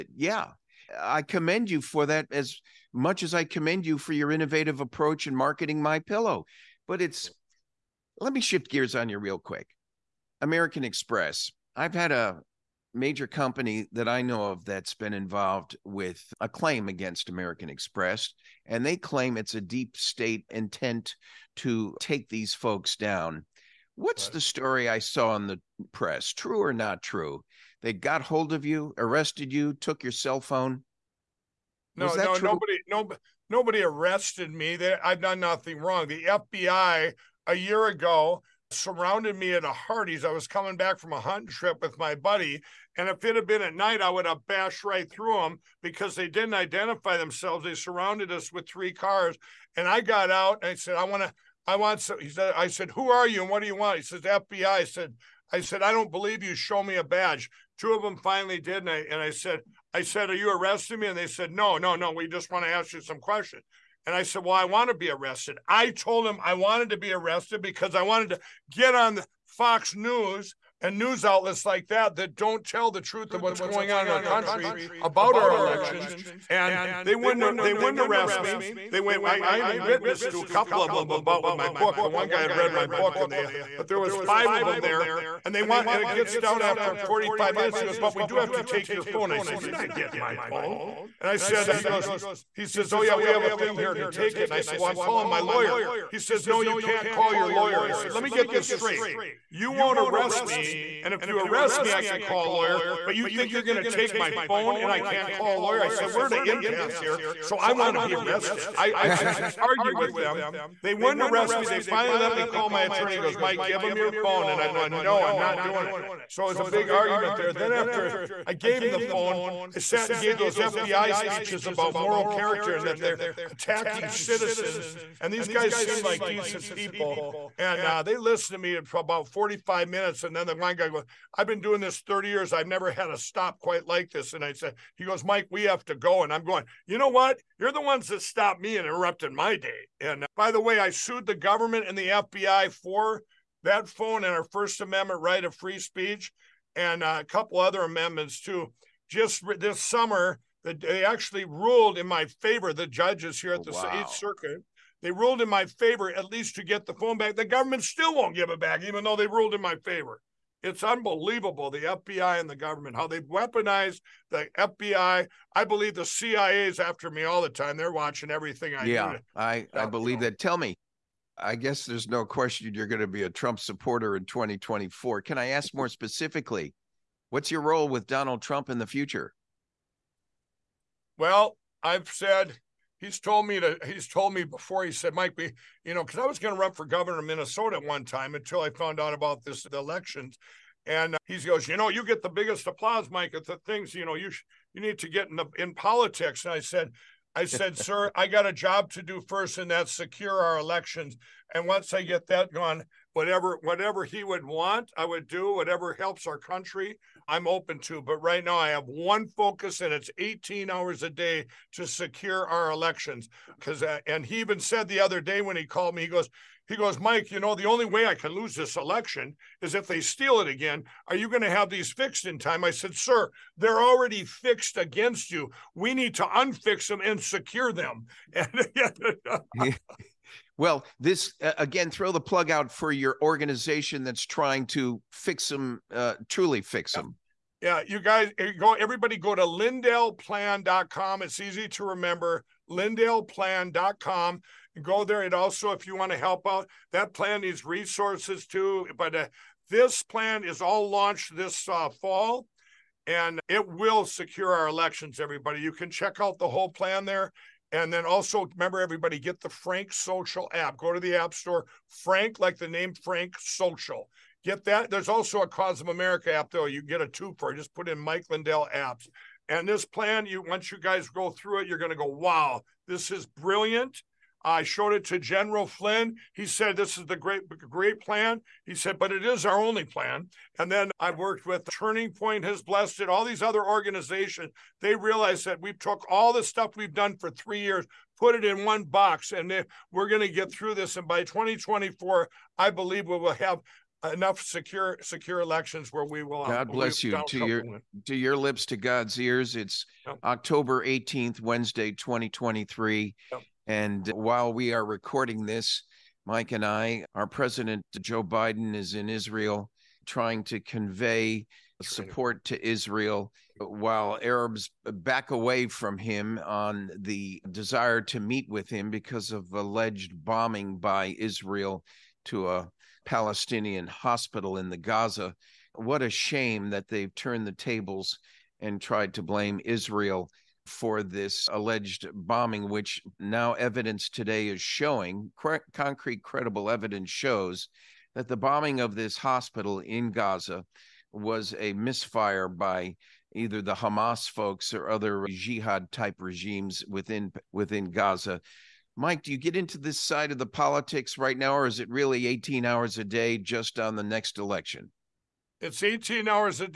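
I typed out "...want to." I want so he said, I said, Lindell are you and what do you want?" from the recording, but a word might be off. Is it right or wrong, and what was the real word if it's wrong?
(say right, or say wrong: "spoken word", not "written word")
wrong: "Who", not "Lindell".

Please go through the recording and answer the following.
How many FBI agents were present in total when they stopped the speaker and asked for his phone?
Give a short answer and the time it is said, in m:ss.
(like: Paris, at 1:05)
5, at 1:24.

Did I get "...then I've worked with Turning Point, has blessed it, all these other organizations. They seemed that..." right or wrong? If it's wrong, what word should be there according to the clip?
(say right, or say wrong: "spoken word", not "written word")
wrong: "realized", not "seemed".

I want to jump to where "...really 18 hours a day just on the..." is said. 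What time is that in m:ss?
5:51.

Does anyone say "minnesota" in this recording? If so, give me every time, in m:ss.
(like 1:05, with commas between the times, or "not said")
3:07.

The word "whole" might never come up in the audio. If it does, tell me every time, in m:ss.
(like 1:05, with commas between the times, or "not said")
4:16.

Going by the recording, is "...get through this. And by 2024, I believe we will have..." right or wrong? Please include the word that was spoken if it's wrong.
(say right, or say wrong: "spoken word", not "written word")
right.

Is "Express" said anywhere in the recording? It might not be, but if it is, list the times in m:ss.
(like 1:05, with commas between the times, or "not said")
0:10, 0:17.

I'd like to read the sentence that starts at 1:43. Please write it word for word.
But you think you're going to take my phone and I can't call a lawyer?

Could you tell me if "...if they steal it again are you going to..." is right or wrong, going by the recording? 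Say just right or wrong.
right.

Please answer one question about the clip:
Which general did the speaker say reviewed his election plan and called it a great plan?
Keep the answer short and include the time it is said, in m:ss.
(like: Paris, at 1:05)
General Flynn, at 4:35.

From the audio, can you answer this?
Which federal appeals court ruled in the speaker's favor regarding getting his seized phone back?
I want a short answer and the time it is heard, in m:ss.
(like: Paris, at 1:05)
Eighth Circuit, at 2:33.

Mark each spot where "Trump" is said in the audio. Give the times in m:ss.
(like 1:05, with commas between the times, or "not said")
2:53, 2:58.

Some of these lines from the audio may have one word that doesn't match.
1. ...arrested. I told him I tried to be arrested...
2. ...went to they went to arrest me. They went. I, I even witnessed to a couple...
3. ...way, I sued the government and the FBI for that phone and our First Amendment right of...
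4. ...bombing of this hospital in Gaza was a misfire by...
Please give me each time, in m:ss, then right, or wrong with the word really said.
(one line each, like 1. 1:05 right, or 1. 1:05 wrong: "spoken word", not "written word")
1. 1:05 wrong: "wanted", not "tried"
2. 1:17 right
3. 2:20 right
4. 5:38 right.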